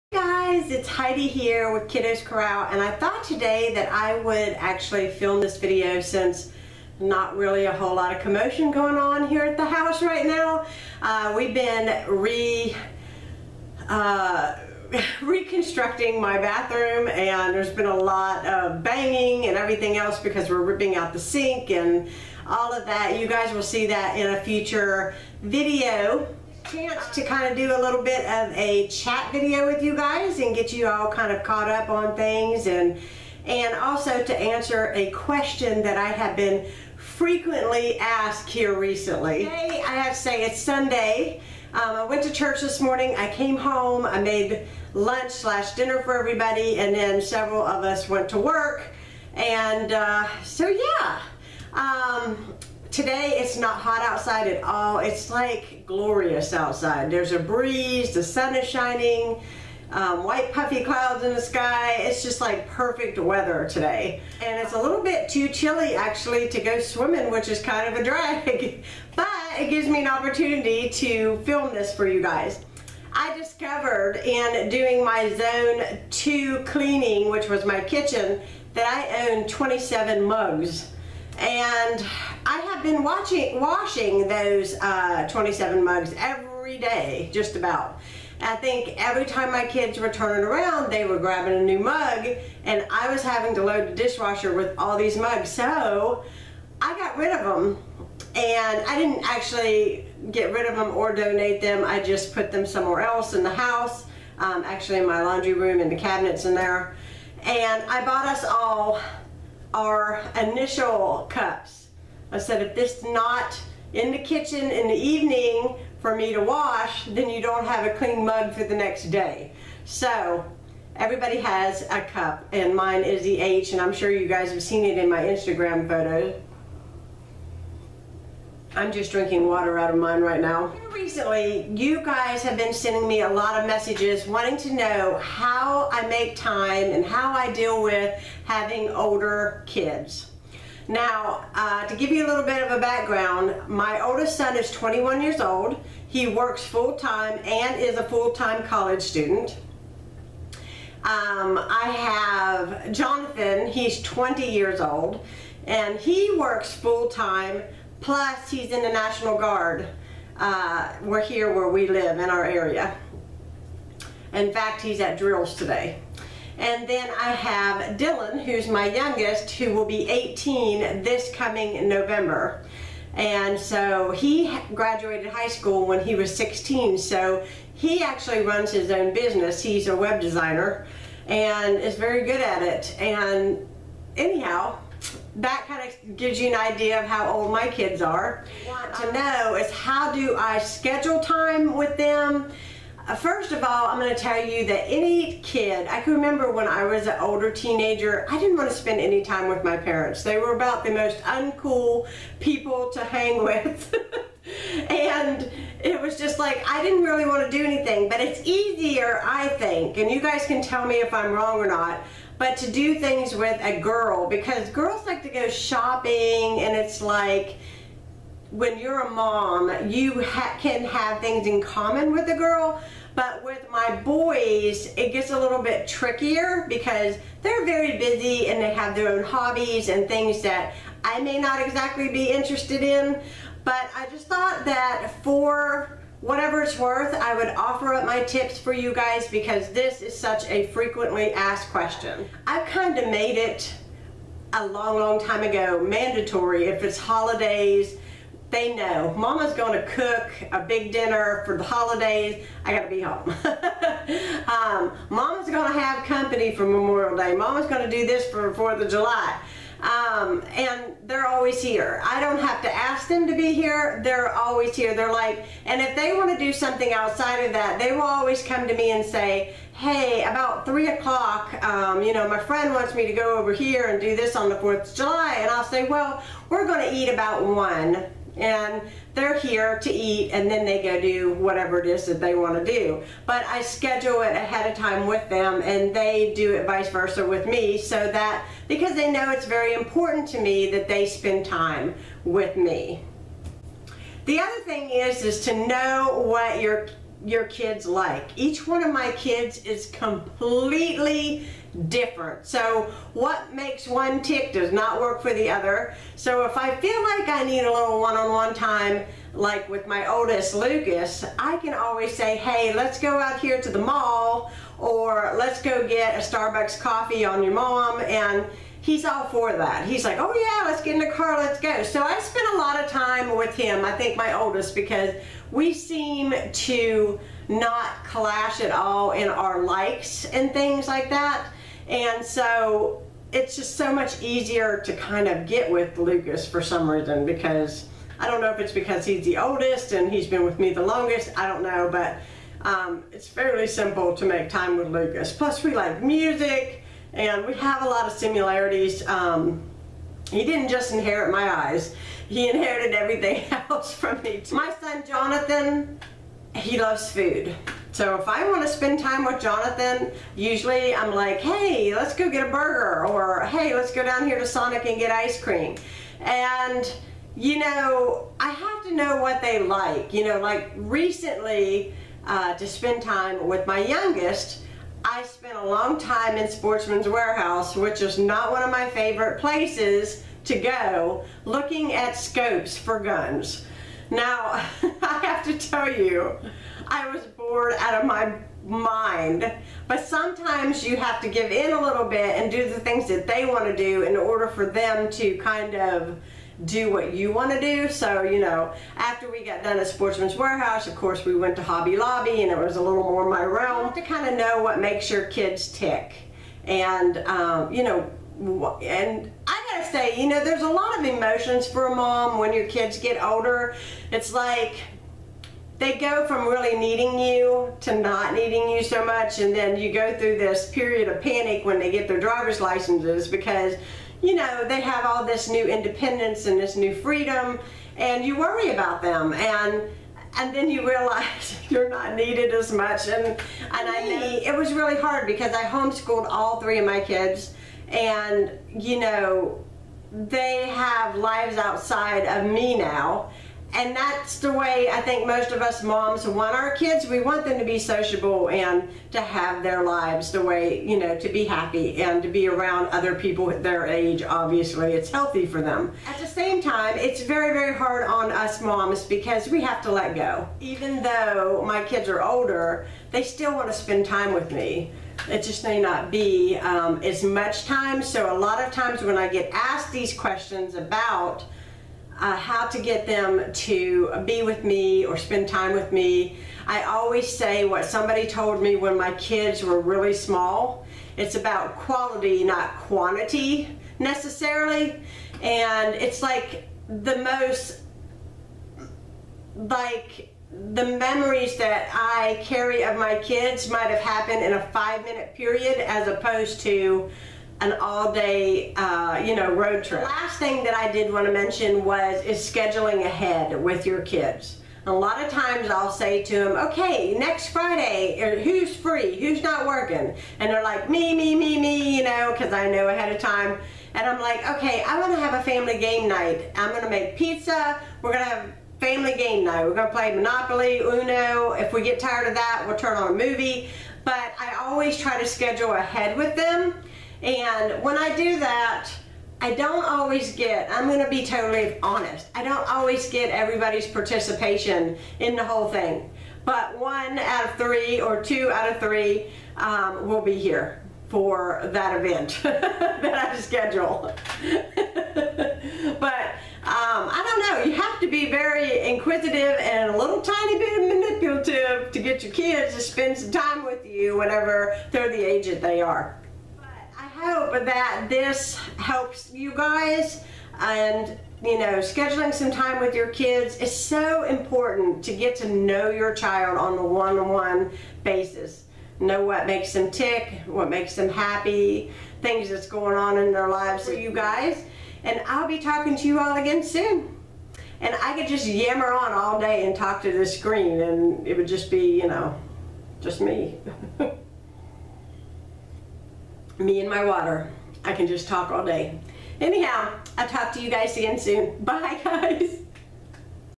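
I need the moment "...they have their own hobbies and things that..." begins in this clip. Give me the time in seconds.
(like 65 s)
228 s.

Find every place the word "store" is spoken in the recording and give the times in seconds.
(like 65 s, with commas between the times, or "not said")
not said.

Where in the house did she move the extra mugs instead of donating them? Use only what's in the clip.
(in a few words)
laundry room.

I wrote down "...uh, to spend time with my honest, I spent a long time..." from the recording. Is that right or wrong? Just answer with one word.
wrong.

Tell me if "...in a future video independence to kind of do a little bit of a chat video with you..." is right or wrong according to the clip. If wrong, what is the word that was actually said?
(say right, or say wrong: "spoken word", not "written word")
wrong: "chance", not "independence".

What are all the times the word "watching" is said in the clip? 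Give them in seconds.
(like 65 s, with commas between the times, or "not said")
83 s.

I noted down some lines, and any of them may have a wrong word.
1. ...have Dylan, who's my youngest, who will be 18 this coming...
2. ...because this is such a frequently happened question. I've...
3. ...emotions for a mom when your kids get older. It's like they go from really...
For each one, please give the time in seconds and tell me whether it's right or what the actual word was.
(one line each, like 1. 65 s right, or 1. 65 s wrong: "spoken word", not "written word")
1. 167 s right
2. 239 s wrong: "asked", not "happened"
3. 411 s right.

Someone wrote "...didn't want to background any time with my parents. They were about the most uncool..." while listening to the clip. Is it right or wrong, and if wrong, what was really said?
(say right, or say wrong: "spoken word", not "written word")
wrong: "spend", not "background".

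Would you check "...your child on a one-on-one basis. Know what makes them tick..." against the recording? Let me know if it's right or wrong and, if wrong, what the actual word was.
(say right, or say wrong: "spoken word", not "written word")
right.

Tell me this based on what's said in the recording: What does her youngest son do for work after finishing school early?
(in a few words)
web designer.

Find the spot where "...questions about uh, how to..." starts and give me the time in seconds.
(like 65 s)
470 s.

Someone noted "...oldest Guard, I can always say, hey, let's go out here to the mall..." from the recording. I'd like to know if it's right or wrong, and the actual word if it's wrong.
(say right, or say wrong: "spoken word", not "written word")
wrong: "Lucas", not "Guard".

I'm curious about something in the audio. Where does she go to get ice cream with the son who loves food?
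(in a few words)
Sonic.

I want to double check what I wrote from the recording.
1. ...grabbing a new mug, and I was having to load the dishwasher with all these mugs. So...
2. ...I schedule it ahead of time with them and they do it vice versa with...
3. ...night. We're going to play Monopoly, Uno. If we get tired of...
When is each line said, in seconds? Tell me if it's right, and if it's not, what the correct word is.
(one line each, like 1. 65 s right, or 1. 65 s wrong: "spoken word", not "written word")
1. 91 s right
2. 283 s right
3. 519 s right.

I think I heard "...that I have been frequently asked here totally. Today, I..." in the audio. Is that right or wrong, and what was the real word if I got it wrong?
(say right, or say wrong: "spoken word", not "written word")
wrong: "recently", not "totally".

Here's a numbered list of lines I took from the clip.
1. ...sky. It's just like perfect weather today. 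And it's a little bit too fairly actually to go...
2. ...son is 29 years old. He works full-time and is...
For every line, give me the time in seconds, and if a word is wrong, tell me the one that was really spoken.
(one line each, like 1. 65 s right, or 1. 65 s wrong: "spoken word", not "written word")
1. 61 s wrong: "chilly", not "fairly"
2. 144 s wrong: "21", not "29".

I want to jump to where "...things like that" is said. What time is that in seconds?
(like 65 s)
330 s.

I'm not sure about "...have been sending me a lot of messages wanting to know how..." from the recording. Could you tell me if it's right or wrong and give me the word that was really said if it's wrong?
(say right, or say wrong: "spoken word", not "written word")
right.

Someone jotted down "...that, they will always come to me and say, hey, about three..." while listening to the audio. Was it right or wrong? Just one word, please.
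right.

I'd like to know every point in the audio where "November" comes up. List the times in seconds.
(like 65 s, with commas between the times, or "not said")
171 s.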